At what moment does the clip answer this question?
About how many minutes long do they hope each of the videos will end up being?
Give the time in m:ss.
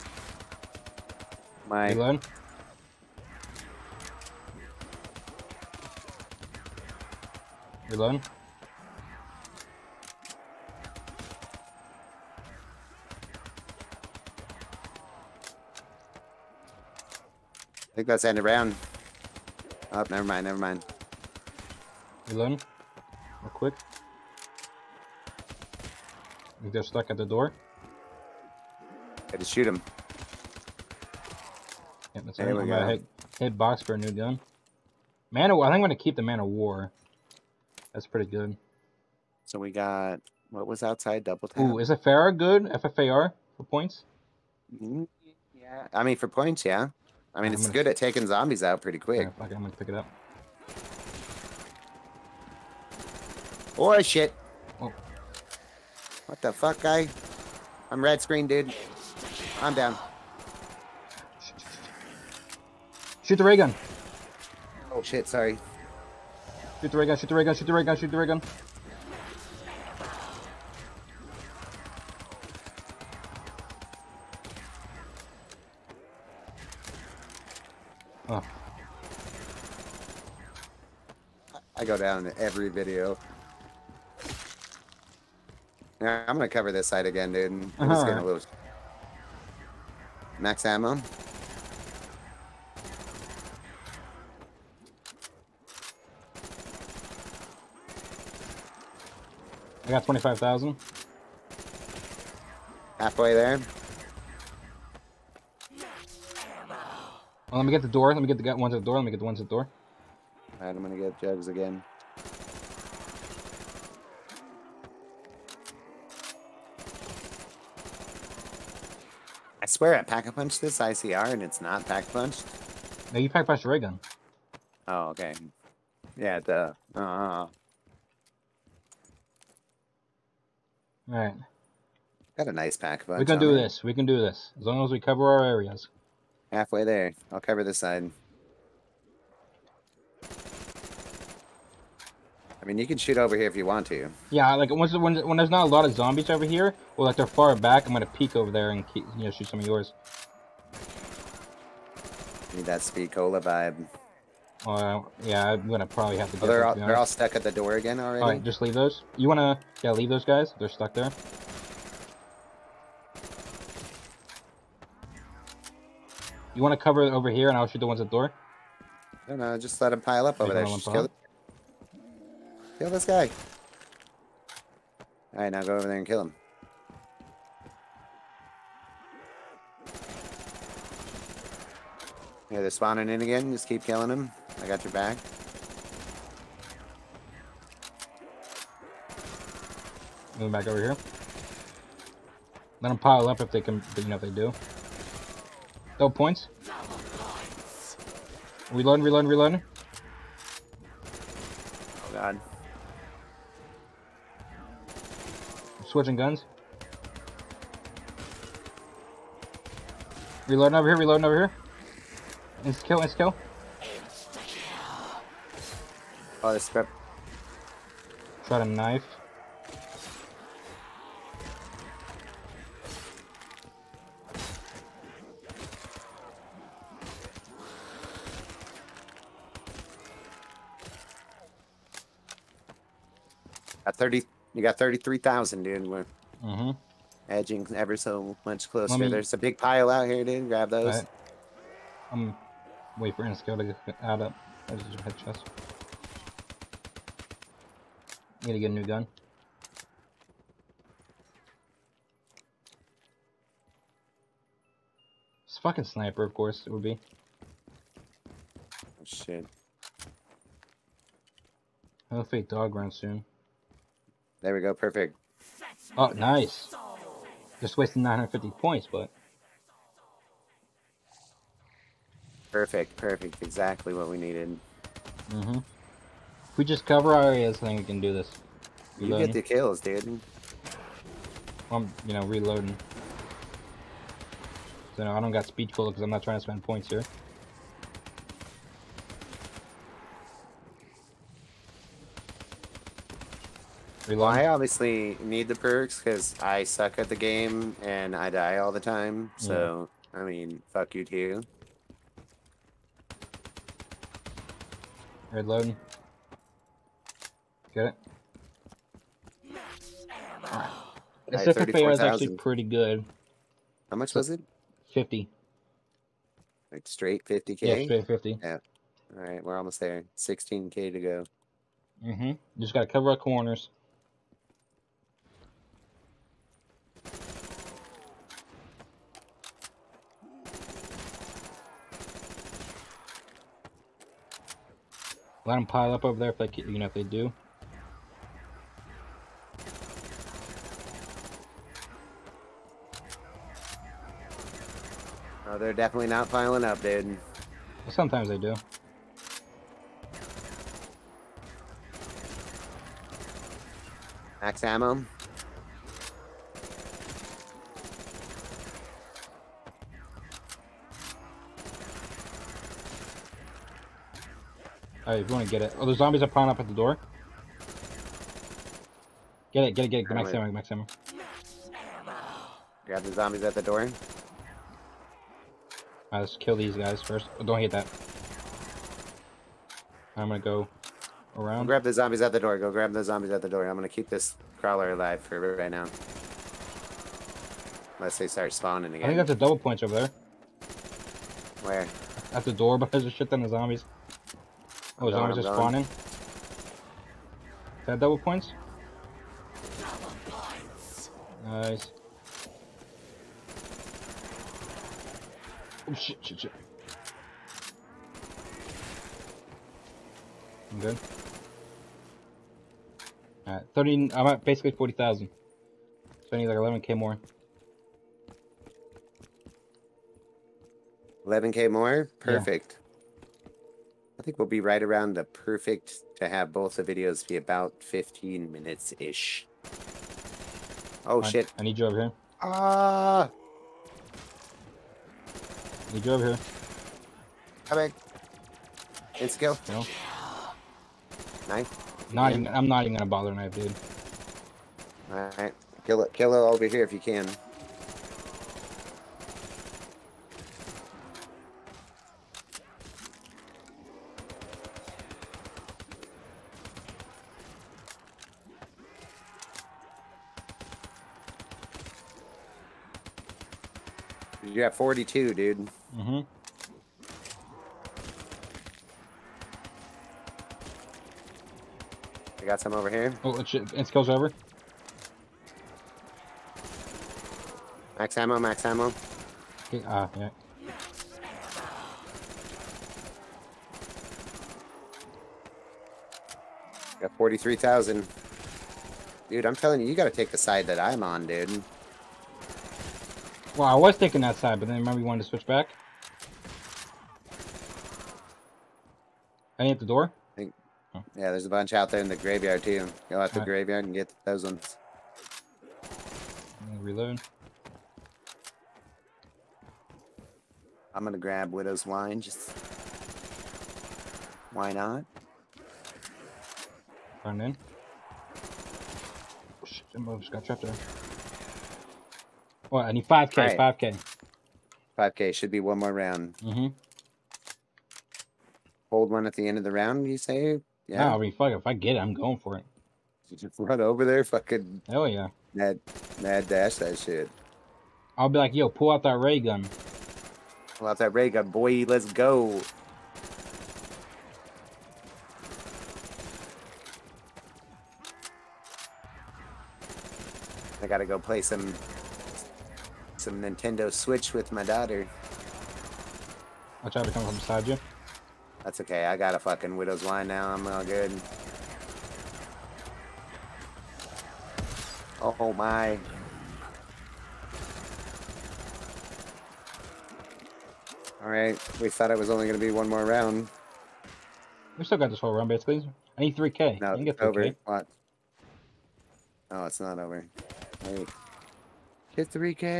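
7:07.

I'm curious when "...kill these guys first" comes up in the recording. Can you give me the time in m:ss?
6:16.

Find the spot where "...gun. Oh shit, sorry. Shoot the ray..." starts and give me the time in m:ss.
1:03.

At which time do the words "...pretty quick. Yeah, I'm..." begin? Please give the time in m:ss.
0:48.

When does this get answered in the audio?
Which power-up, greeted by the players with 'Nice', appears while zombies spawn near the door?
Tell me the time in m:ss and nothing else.
6:37.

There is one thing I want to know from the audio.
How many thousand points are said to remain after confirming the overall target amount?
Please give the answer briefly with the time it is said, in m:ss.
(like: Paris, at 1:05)
16k, at 5:20.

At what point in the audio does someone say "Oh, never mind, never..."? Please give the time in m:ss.
0:19.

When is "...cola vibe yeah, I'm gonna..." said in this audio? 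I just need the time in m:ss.
2:33.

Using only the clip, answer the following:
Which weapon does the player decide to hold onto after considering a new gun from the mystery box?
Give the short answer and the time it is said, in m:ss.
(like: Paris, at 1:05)
Man-O-War, at 0:36.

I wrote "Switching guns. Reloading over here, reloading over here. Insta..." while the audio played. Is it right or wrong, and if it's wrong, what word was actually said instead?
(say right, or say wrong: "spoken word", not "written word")
right.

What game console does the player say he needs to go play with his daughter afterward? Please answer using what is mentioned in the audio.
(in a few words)
Nintendo Switch.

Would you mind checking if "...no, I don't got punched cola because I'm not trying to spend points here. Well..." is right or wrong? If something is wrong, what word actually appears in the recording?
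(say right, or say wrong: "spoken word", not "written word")
wrong: "speed", not "punched".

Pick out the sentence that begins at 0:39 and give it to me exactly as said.
So we got what was outside double tap.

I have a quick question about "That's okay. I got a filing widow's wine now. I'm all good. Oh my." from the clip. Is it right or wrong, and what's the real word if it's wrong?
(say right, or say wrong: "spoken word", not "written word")
wrong: "fucking", not "filing".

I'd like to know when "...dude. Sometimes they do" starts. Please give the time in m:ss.
5:46.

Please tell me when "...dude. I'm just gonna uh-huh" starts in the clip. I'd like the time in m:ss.
1:27.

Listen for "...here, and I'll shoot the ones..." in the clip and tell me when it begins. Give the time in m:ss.
2:47.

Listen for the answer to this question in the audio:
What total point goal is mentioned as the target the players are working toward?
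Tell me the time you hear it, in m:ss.
5:17.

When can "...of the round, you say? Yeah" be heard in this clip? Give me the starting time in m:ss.
8:49.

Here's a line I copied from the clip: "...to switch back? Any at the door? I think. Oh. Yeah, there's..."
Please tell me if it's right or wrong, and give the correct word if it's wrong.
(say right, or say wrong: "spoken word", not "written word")
right.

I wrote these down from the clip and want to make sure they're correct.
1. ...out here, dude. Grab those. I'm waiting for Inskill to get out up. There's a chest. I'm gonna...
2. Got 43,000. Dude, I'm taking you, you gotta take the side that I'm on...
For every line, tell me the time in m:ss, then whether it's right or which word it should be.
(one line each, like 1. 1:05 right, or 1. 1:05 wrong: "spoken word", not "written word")
1. 3:59 right
2. 8:06 wrong: "telling", not "taking".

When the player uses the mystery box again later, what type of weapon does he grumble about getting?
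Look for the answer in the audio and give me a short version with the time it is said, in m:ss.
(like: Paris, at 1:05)
Sniper, at 4:15.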